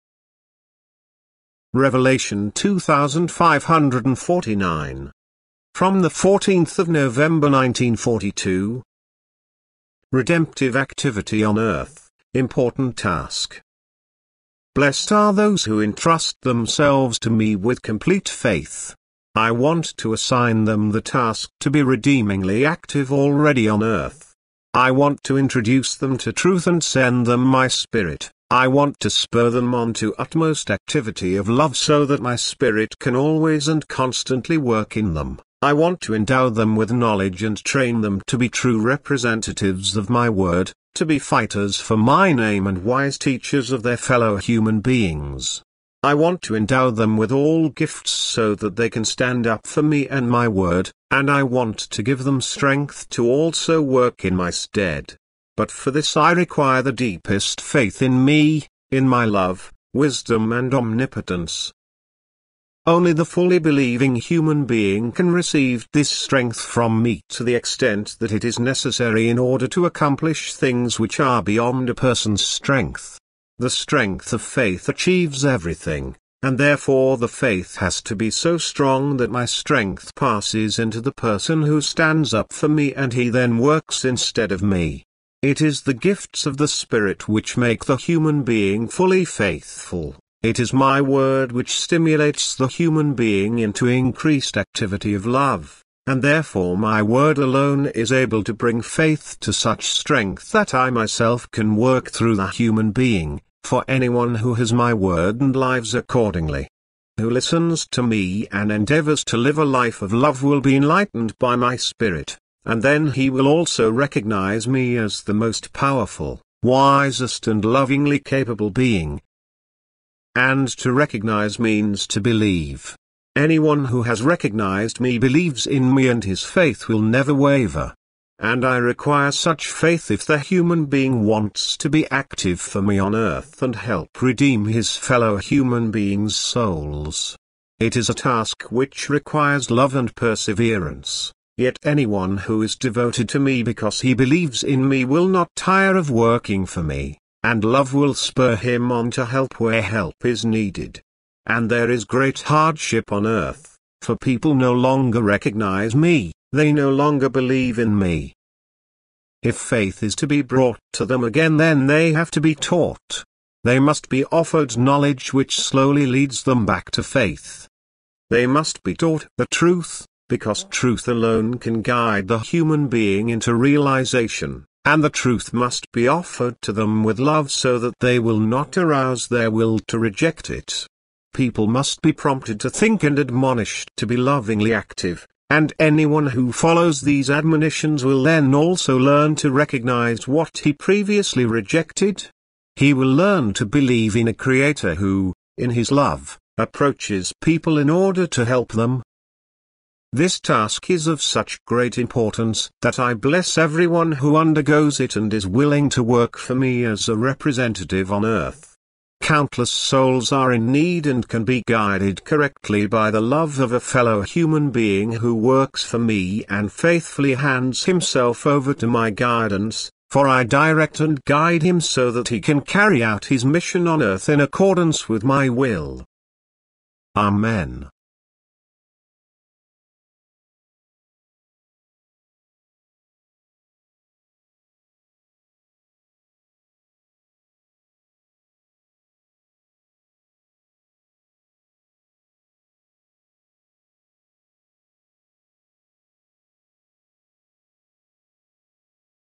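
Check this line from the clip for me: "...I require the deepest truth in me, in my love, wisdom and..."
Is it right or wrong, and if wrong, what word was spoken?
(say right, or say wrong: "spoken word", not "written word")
wrong: "faith", not "truth".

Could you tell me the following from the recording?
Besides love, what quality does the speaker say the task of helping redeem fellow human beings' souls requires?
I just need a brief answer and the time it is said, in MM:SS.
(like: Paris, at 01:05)
Perseverance, at 02:20.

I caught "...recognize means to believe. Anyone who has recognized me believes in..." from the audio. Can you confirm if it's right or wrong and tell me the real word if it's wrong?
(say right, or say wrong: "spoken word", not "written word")
right.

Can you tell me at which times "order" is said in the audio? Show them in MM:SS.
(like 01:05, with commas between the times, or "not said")
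01:09, 03:17.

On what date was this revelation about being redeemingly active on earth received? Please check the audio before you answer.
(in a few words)
14 November 1942.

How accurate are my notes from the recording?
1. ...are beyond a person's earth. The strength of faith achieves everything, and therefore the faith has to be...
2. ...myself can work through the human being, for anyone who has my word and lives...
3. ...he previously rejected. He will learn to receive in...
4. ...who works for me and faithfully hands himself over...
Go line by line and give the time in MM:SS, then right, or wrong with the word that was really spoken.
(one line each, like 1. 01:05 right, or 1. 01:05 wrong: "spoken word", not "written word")
1. 01:11 wrong: "strength", not "earth"
2. 01:40 right
3. 03:10 wrong: "believe", not "receive"
4. 03:35 right.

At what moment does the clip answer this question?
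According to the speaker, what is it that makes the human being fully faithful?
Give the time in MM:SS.
01:25.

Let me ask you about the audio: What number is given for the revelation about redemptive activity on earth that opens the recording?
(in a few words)
2549.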